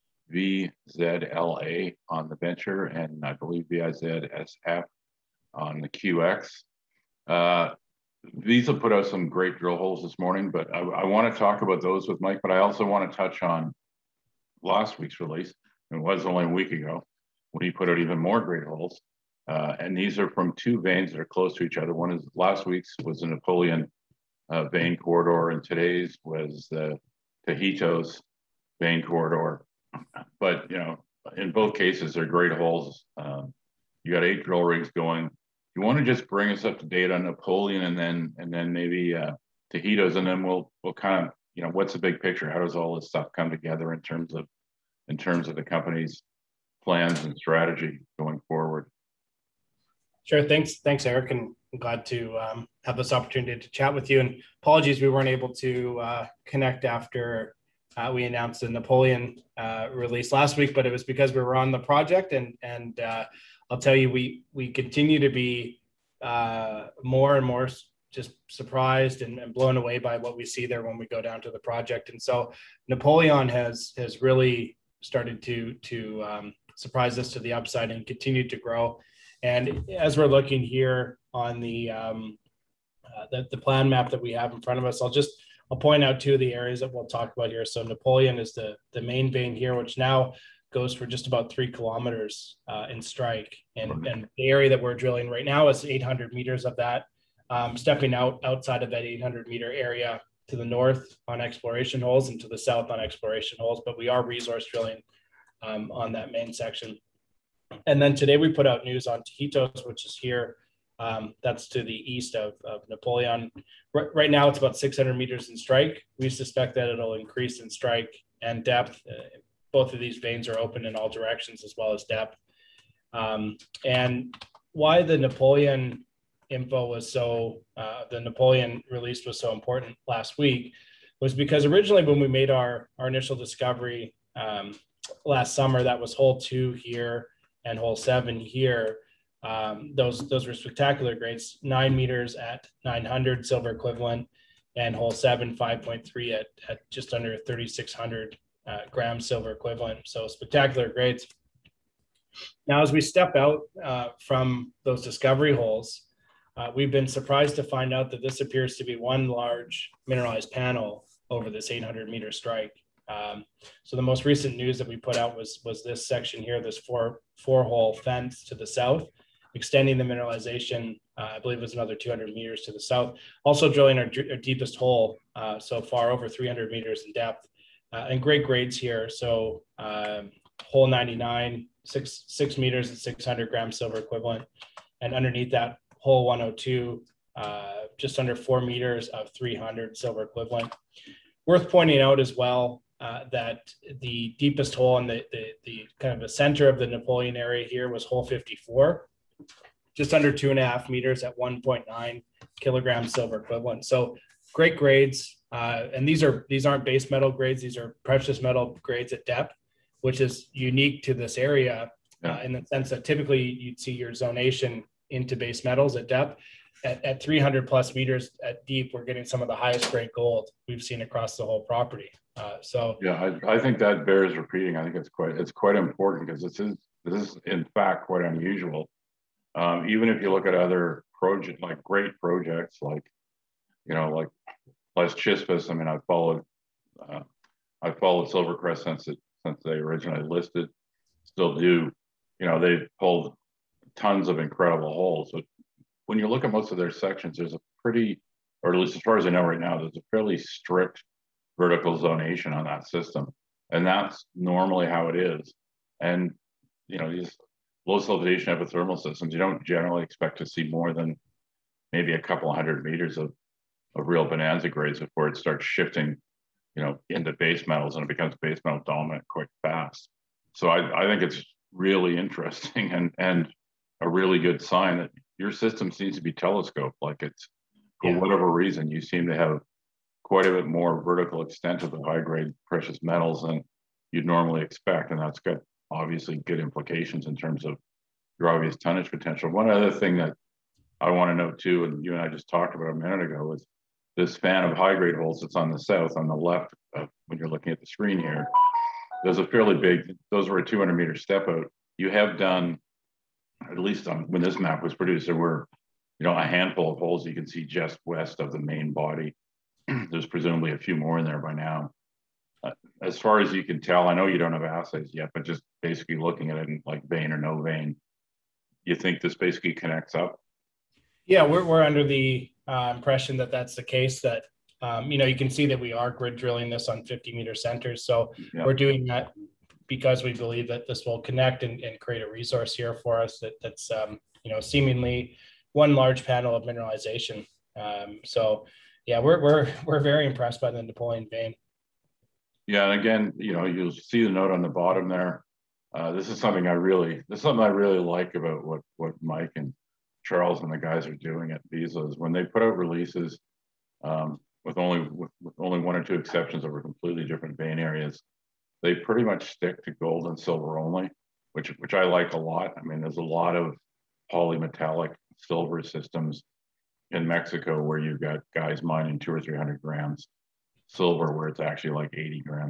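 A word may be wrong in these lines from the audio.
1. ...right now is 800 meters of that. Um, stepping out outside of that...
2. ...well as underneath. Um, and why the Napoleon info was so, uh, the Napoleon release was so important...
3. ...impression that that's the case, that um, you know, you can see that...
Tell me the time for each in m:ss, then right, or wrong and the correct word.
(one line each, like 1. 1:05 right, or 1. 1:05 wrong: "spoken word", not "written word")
1. 1:35 right
2. 2:01 wrong: "depth", not "underneath"
3. 5:22 right.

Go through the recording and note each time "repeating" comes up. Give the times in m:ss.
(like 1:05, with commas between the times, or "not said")
3:44.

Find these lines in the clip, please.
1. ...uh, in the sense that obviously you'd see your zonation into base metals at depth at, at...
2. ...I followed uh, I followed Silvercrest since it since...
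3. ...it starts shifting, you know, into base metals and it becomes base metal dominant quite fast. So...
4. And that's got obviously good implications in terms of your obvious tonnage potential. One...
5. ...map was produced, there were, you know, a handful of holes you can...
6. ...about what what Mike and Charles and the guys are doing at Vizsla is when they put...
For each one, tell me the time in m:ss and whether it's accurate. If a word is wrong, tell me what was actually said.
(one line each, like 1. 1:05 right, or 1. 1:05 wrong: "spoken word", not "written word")
1. 3:32 wrong: "typically", not "obviously"
2. 3:55 right
3. 4:25 right
4. 4:45 right
5. 5:04 right
6. 5:48 right.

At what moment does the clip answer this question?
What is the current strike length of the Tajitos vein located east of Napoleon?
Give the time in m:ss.
1:54.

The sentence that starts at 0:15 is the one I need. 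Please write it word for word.
It was only a week ago when he put out even more great holes.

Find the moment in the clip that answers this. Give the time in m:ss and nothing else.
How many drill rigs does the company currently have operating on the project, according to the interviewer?
0:34.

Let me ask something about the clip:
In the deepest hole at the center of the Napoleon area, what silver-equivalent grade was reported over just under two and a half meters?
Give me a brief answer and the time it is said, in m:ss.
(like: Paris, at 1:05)
1.9 kg/t silver equivalent, at 3:21.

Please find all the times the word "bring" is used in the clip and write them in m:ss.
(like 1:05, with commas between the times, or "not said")
0:36.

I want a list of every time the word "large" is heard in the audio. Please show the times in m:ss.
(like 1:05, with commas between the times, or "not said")
2:39, 5:35.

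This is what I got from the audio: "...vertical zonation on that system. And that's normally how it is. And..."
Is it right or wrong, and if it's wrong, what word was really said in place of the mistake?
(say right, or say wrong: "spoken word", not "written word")
right.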